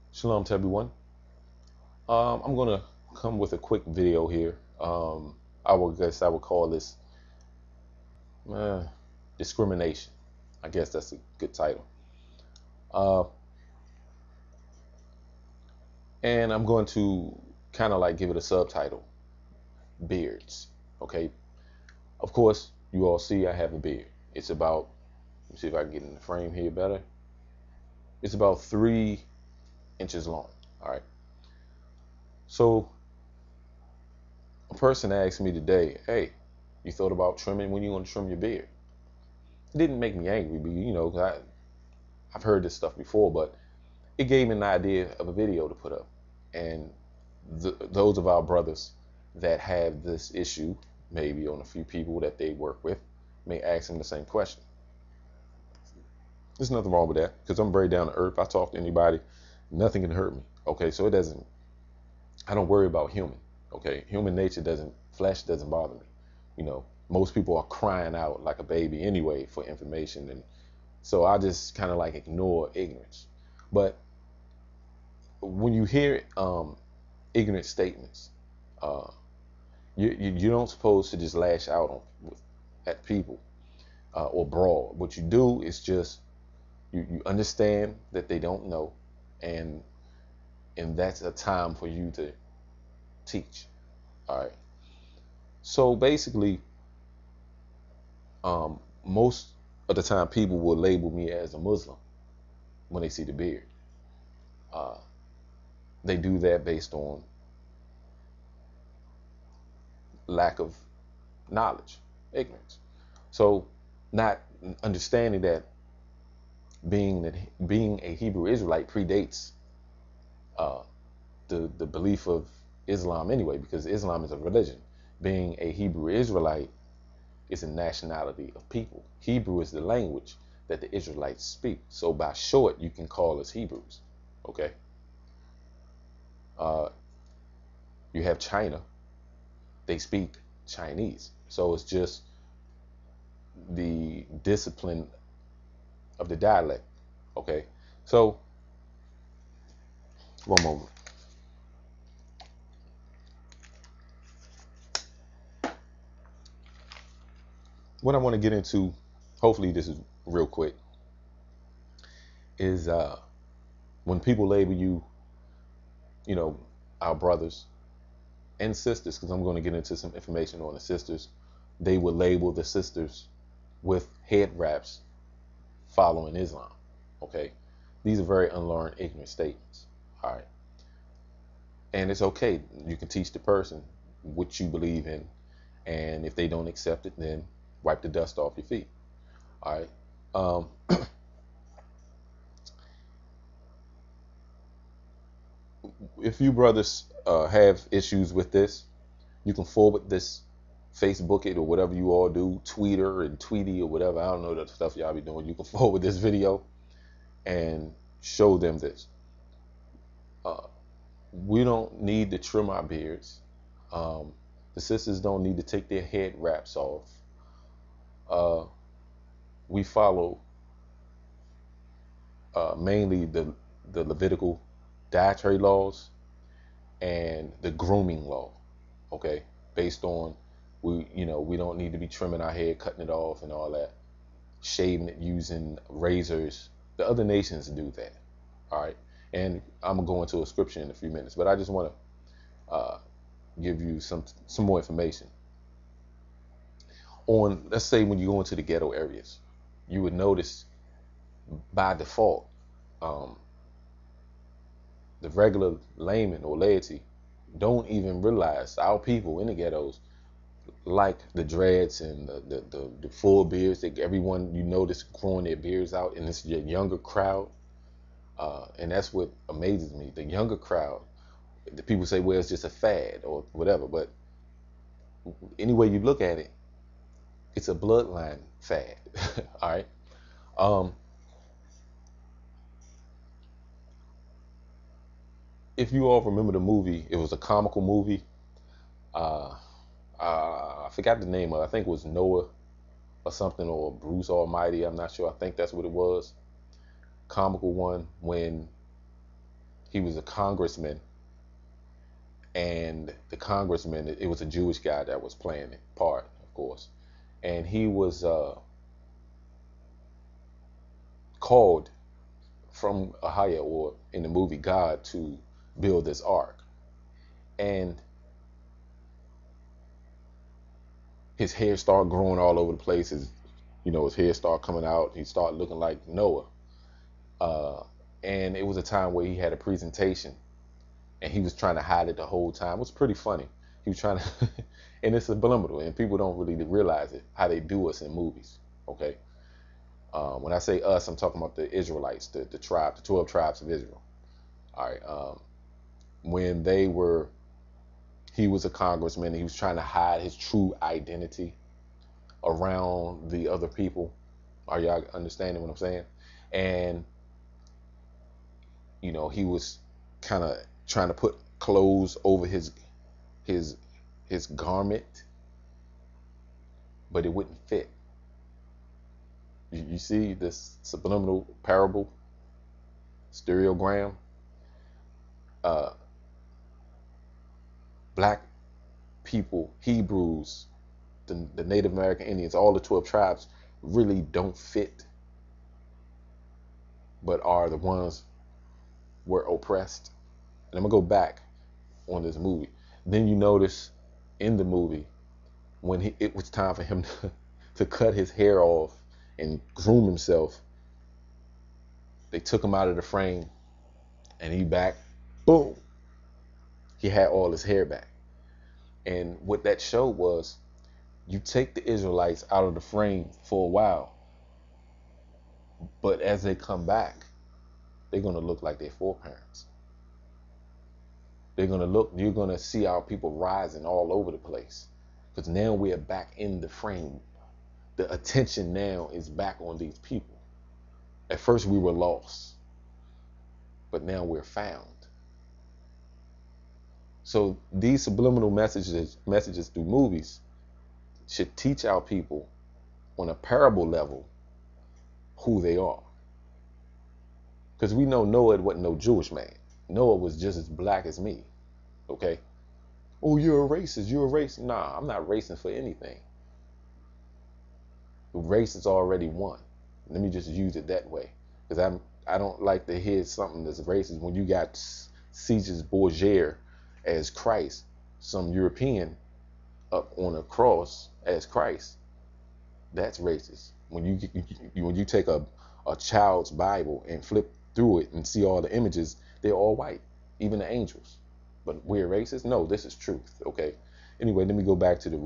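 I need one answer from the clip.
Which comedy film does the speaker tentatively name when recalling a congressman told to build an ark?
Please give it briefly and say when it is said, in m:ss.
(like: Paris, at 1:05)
Bruce Almighty, at 4:53.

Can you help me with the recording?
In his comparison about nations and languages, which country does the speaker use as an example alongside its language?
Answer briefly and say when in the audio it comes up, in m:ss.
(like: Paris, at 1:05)
China, at 2:18.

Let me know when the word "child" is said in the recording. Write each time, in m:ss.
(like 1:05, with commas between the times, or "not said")
7:55.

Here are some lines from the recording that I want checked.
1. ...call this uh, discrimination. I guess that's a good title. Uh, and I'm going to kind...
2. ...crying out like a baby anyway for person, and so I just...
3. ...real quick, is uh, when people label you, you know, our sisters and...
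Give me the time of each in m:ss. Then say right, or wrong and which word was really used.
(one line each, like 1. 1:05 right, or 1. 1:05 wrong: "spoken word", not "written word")
1. 0:06 right
2. 1:07 wrong: "information", not "person"
3. 2:40 wrong: "brothers", not "sisters".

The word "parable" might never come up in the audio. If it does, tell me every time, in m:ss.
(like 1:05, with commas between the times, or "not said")
6:11, 7:23.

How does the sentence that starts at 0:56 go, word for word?
There's nothing wrong with that because I'm very down to earth.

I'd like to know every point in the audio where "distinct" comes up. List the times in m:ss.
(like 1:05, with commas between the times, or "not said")
not said.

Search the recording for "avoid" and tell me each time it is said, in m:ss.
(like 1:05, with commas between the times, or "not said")
not said.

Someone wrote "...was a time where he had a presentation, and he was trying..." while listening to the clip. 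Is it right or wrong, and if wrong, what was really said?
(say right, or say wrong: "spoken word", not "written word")
right.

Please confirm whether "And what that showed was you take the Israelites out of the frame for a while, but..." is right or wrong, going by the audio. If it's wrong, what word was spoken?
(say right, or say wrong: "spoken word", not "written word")
right.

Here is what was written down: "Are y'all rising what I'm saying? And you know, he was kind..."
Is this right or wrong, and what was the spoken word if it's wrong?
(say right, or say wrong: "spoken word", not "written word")
wrong: "understanding", not "rising".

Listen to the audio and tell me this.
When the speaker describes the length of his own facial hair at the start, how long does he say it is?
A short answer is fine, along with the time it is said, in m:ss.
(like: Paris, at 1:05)
3 inches, at 0:28.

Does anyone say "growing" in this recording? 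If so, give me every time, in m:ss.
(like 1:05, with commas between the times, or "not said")
4:25, 5:22.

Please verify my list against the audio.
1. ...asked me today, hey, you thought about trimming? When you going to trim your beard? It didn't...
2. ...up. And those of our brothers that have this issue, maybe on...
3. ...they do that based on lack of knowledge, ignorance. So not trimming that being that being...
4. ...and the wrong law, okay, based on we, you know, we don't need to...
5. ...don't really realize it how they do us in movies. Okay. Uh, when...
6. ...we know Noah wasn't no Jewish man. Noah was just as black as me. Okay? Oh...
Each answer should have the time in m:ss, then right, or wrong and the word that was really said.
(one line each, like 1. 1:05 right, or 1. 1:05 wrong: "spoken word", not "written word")
1. 0:35 right
2. 0:45 right
3. 1:46 wrong: "understanding", not "trimming"
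4. 3:47 wrong: "grooming", not "wrong"
5. 5:36 right
6. 7:27 right.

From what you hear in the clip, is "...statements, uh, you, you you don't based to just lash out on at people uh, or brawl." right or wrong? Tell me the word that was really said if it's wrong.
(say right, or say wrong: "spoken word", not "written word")
wrong: "supposed", not "based".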